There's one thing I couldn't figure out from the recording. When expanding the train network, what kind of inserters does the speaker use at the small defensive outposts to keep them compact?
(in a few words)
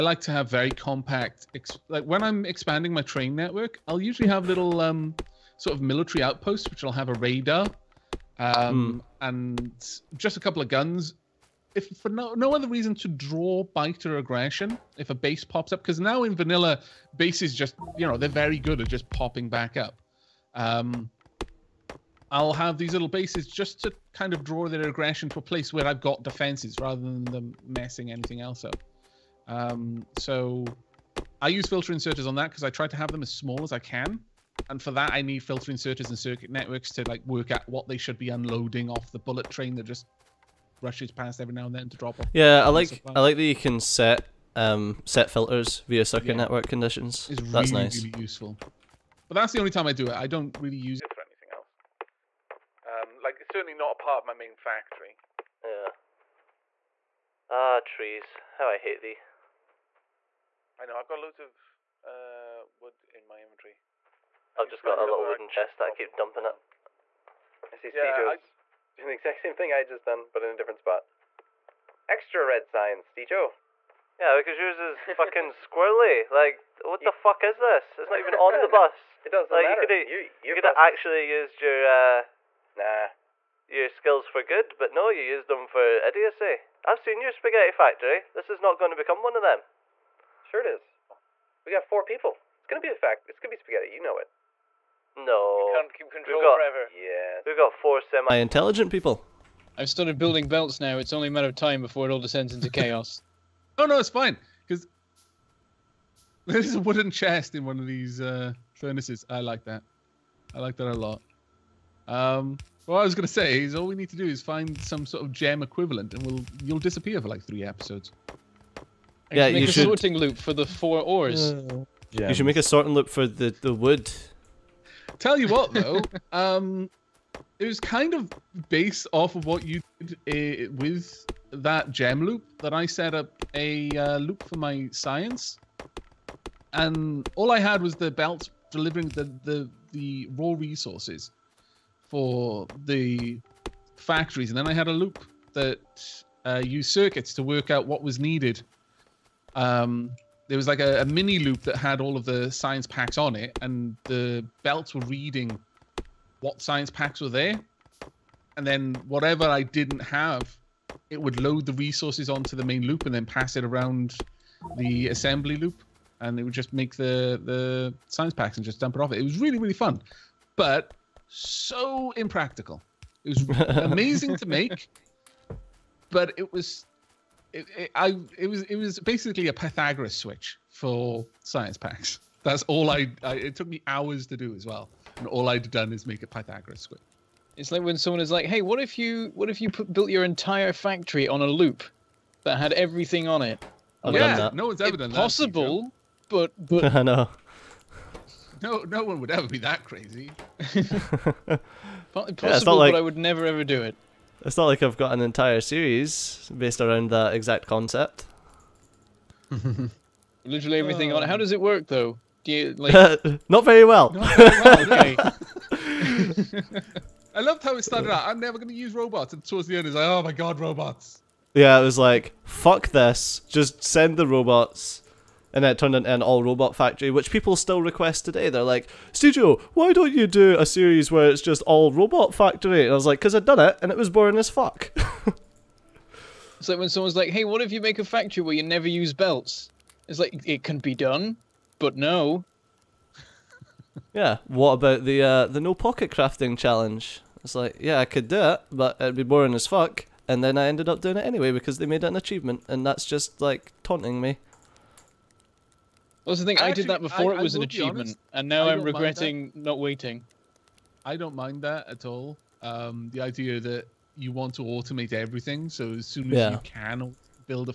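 filter inserters.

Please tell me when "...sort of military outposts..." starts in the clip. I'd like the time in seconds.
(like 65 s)
5 s.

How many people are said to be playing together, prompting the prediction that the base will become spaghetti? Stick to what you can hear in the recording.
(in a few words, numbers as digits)
4.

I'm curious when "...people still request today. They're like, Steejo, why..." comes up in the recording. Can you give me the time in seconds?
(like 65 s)
227 s.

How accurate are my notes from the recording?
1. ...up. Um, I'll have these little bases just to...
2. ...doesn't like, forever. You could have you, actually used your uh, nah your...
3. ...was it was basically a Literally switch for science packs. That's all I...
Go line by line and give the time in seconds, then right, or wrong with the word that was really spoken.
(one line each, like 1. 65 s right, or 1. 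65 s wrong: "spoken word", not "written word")
1. 19 s right
2. 79 s wrong: "matter", not "forever"
3. 178 s wrong: "Pythagoras", not "Literally".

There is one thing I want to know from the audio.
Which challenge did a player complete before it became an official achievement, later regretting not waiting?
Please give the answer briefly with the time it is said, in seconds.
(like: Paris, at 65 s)
no pocket crafting, at 245 s.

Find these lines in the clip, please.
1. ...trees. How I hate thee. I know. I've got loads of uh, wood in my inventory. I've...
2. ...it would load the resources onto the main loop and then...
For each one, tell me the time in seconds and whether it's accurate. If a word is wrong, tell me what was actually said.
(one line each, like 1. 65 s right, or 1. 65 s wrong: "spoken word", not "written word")
1. 57 s right
2. 161 s right.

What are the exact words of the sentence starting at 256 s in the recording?
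I, I actually, did that before I, it was an achievement, honest, and now I am regretting not waiting.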